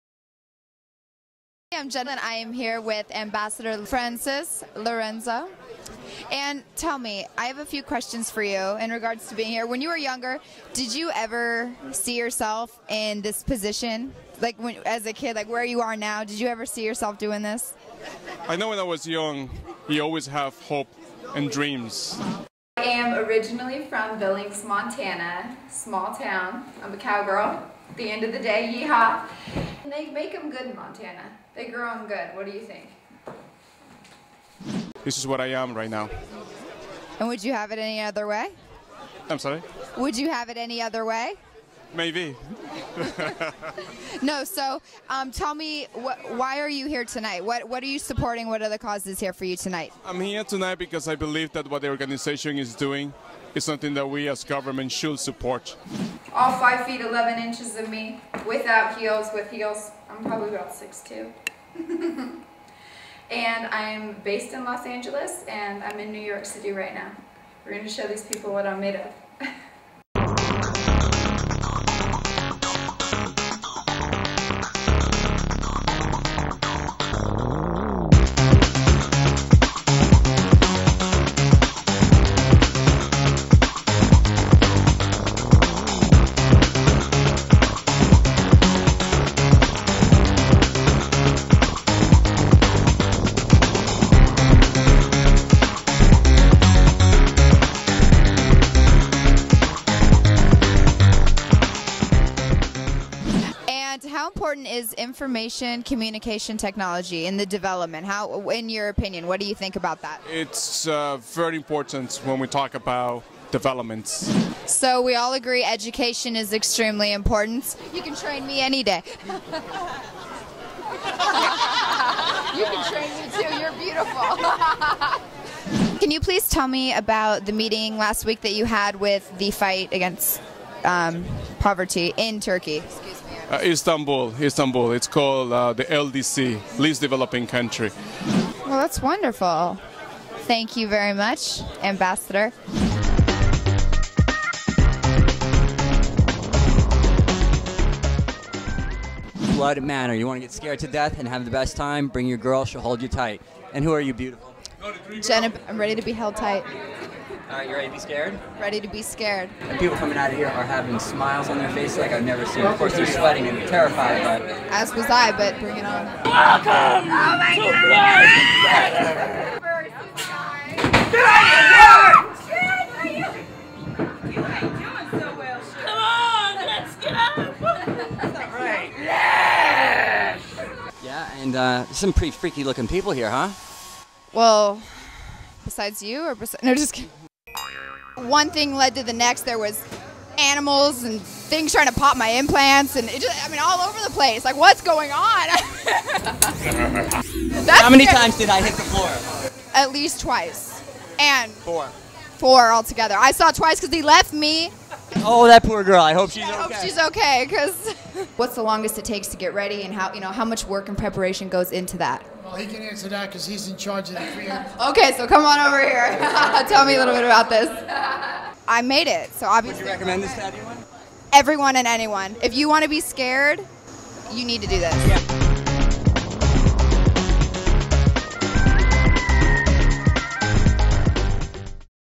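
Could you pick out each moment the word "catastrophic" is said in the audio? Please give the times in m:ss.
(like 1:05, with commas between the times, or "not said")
not said.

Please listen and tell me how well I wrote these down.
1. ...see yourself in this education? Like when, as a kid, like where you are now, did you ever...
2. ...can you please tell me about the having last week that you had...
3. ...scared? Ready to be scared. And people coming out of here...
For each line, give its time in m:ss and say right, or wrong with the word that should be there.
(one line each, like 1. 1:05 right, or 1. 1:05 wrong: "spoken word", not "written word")
1. 0:11 wrong: "position", not "education"
2. 2:05 wrong: "meeting", not "having"
3. 2:37 right.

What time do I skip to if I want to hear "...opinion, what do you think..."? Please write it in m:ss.
1:48.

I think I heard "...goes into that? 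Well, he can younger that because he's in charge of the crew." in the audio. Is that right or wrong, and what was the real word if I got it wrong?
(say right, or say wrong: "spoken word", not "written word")
wrong: "answer", not "younger".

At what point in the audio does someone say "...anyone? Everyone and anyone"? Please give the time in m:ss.
3:40.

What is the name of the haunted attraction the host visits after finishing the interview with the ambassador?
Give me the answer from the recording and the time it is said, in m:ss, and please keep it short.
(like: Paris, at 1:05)
Blood Manor, at 2:29.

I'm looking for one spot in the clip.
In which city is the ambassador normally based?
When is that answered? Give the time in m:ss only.
1:04.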